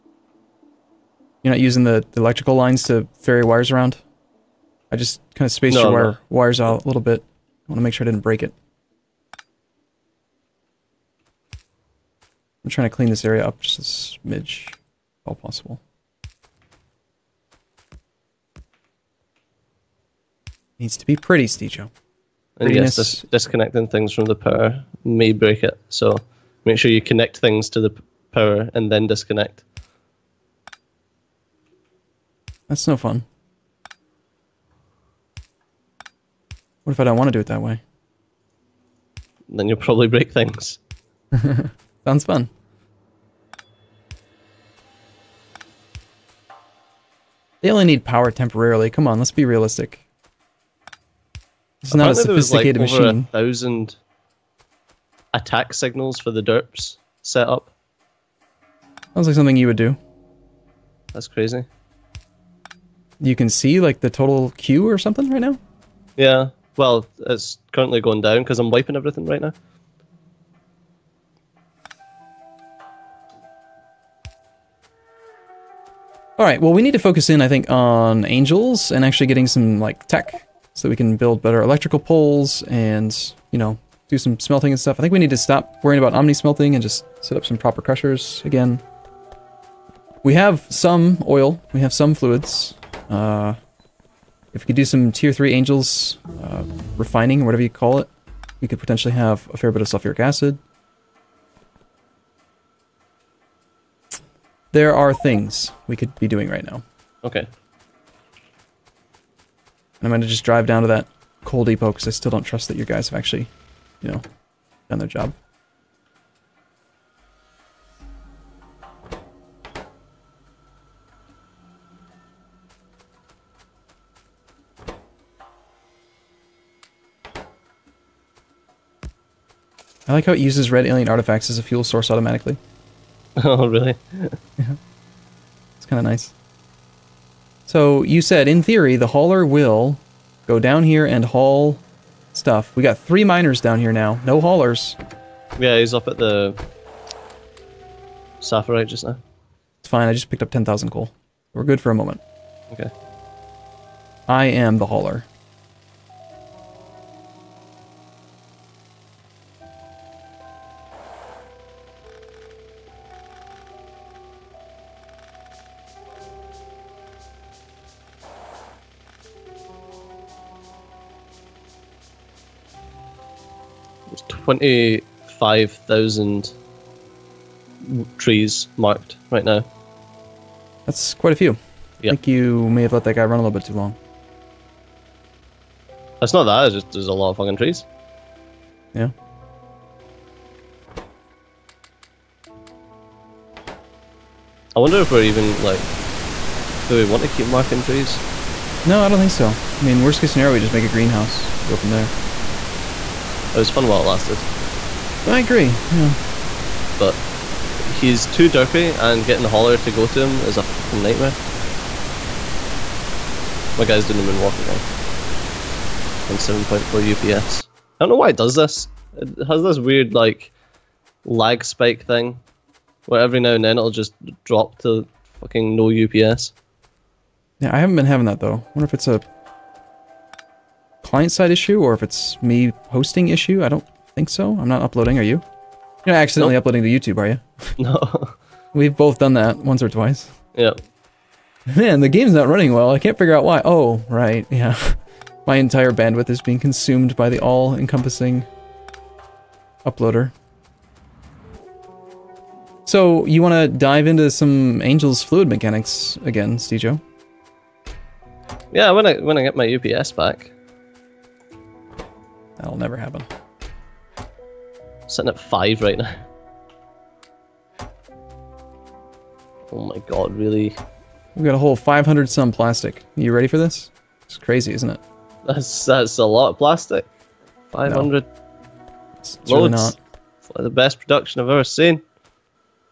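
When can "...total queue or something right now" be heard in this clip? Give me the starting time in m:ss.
1:04.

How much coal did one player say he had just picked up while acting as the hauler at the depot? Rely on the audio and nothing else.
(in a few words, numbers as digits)
10,000.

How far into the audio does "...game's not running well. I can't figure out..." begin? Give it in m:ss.
4:02.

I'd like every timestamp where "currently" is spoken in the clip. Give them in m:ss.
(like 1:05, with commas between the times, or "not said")
1:07.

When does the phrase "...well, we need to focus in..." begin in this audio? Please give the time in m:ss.
1:16.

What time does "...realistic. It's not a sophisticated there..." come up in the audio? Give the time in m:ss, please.
0:49.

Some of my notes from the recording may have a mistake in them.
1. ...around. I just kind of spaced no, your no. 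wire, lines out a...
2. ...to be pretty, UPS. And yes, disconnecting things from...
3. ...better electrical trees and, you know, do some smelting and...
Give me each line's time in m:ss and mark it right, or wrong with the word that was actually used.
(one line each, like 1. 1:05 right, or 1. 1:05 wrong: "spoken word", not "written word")
1. 0:03 wrong: "wires", not "lines"
2. 0:20 wrong: "Steejo", not "UPS"
3. 1:21 wrong: "poles", not "trees".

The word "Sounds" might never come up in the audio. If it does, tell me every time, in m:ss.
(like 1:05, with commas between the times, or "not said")
0:42, 0:59.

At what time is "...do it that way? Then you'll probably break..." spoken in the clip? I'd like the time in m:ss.
0:37.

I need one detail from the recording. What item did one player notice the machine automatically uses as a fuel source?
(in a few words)
Red alien artifacts.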